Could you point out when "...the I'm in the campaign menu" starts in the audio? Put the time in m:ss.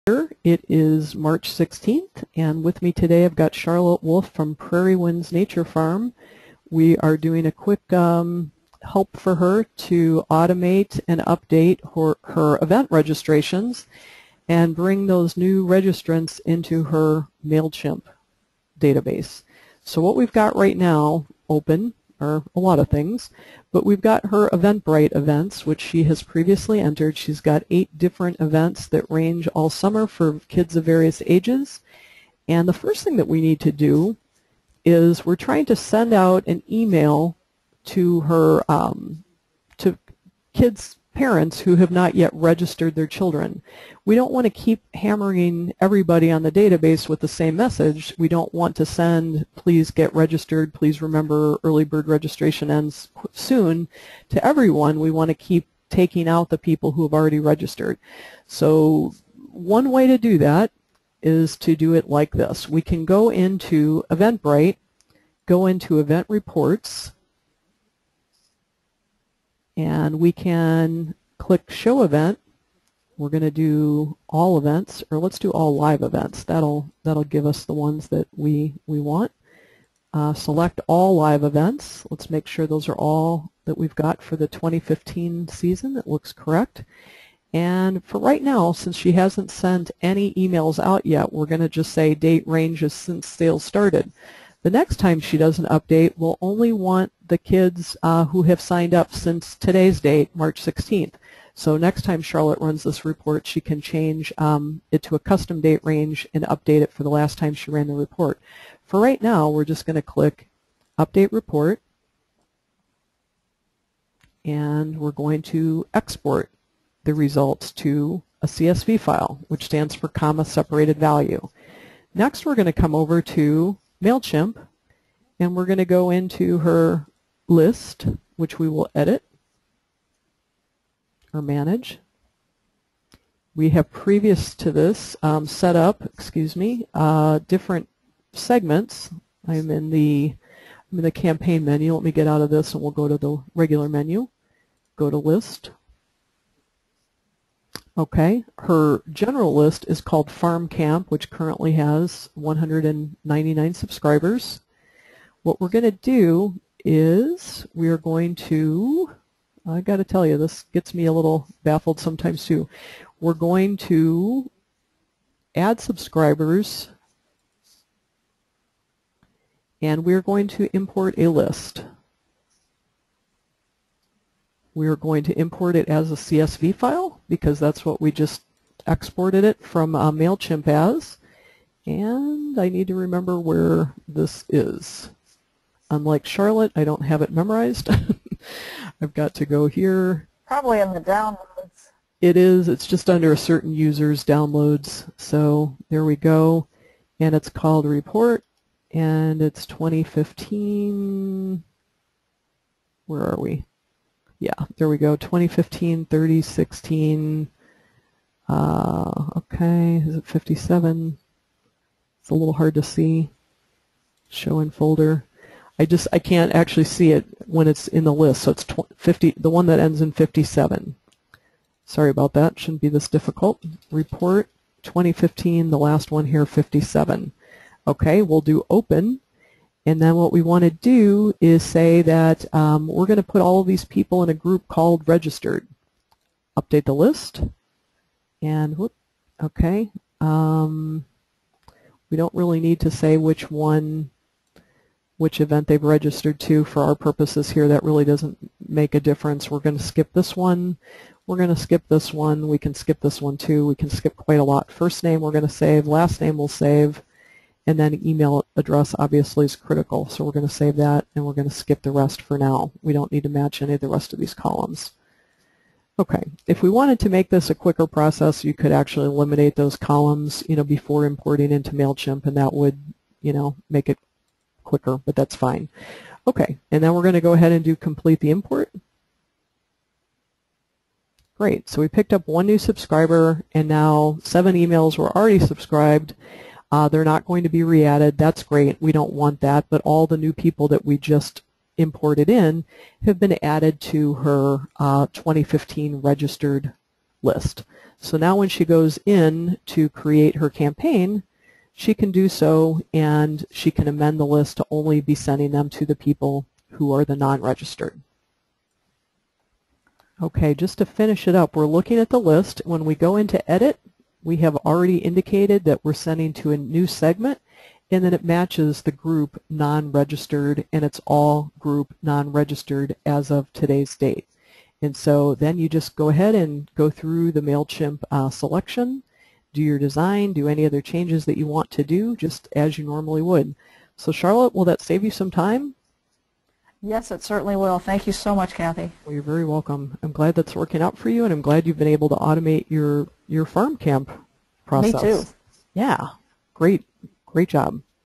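2:19.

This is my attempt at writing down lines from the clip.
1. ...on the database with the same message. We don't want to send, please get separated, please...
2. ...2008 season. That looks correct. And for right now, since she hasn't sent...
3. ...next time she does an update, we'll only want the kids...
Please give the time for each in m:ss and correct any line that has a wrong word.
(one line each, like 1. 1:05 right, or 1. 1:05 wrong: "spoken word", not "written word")
1. 0:46 wrong: "registered", not "separated"
2. 1:24 wrong: "2015", not "2008"
3. 1:34 right.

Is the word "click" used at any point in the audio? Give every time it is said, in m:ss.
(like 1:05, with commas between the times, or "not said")
1:11, 1:50.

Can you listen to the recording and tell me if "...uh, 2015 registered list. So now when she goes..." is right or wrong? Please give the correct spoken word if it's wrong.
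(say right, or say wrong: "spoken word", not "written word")
right.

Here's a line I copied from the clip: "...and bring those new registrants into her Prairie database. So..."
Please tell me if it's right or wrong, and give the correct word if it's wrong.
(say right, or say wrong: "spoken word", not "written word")
wrong: "MailChimp", not "Prairie".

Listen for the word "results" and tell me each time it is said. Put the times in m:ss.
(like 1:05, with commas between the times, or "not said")
1:57.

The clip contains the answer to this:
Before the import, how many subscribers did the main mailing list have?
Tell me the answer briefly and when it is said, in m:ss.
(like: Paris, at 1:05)
199, at 2:32.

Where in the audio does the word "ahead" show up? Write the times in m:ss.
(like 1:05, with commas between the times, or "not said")
4:37, 5:26.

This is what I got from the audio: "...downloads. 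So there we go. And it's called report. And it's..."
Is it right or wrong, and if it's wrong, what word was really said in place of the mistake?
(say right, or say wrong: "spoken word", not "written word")
right.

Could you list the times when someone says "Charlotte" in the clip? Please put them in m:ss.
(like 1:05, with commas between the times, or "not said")
0:03, 1:42, 3:06, 5:34.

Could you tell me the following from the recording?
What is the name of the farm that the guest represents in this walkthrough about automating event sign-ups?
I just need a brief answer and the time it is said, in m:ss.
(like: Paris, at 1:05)
Prairie Winds Nature Farm, at 0:04.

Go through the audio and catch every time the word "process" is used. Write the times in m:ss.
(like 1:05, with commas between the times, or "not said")
4:27, 5:44.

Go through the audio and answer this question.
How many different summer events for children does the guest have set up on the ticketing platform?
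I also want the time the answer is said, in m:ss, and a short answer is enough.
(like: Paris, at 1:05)
8, at 0:27.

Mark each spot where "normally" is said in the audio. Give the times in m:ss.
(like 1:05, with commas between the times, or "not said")
5:32.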